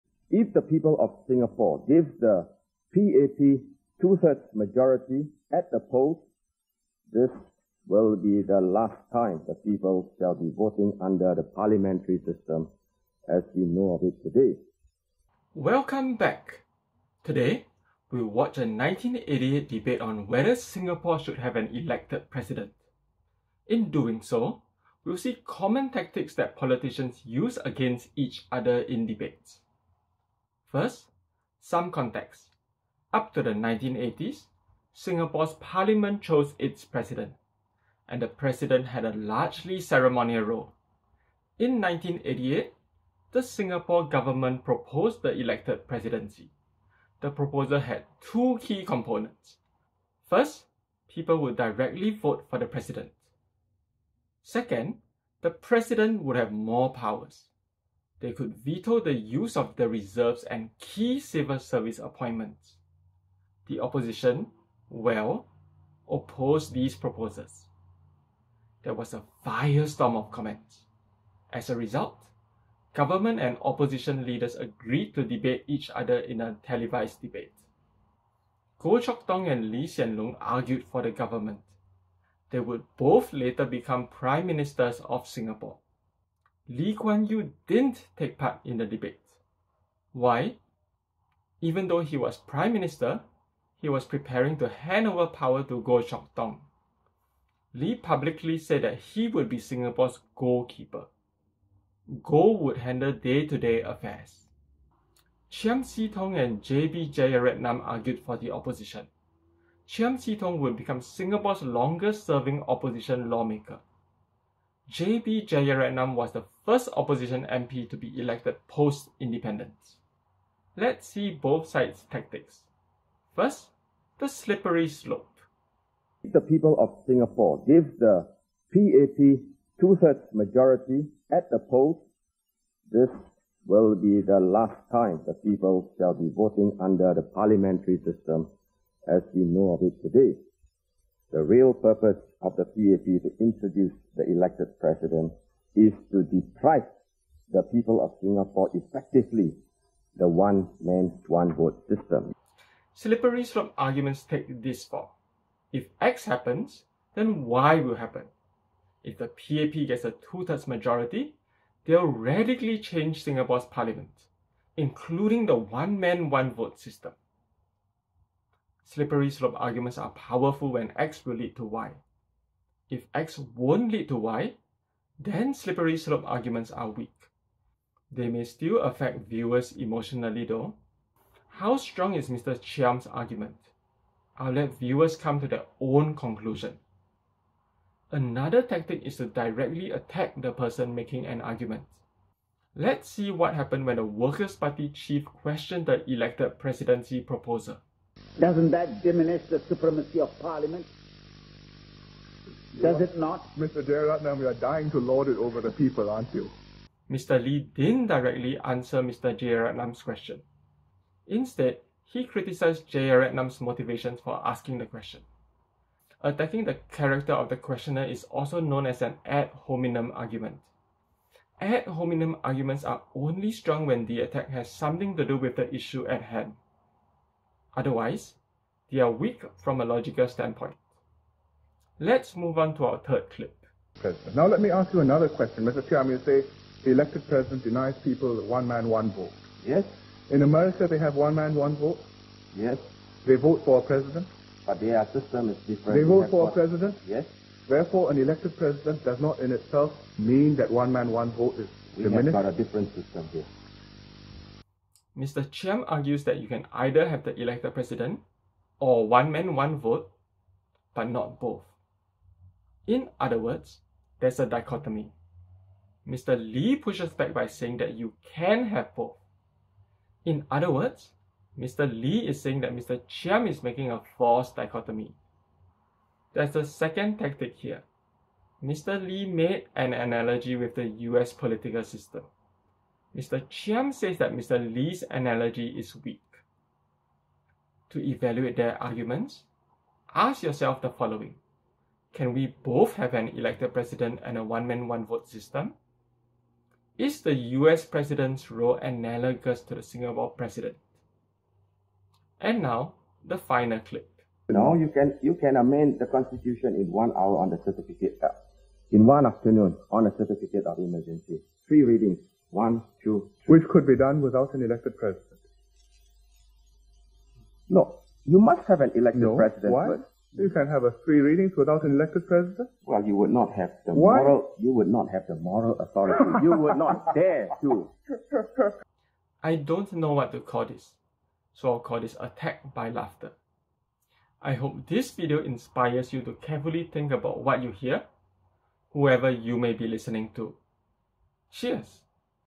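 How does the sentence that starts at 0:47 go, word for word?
The proposal had two key components.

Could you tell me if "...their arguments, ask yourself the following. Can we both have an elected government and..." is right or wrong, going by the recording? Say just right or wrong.
wrong.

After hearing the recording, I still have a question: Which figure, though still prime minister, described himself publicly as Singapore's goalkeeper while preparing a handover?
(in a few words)
Lee Kuan Yew.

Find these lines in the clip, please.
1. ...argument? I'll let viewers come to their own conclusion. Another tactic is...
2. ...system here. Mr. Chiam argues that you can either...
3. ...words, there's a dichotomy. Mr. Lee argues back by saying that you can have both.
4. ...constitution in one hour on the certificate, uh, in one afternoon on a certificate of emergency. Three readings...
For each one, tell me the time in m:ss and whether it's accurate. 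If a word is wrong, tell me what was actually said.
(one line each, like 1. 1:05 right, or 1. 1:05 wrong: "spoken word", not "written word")
1. 3:03 right
2. 4:12 right
3. 4:23 wrong: "pushes", not "argues"
4. 5:06 right.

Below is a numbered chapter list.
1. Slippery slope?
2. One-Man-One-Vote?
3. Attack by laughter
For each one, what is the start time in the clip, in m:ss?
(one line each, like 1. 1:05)
1. 2:06
2. 3:54
3. 5:05.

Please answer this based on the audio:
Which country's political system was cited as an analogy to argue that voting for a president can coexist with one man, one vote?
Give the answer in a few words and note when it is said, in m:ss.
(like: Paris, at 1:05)
America, at 4:00.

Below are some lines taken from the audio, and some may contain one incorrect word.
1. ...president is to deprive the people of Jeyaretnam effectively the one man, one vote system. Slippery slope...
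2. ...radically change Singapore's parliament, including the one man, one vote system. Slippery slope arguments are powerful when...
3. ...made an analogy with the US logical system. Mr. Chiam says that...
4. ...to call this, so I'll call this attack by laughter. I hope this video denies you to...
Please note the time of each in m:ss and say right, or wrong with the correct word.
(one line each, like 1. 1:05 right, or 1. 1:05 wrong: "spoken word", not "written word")
1. 2:24 wrong: "Singapore", not "Jeyaretnam"
2. 2:42 right
3. 4:39 wrong: "political", not "logical"
4. 5:30 wrong: "inspires", not "denies".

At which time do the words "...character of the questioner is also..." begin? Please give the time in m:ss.
3:36.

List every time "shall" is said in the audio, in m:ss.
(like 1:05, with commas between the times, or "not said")
0:10, 2:15.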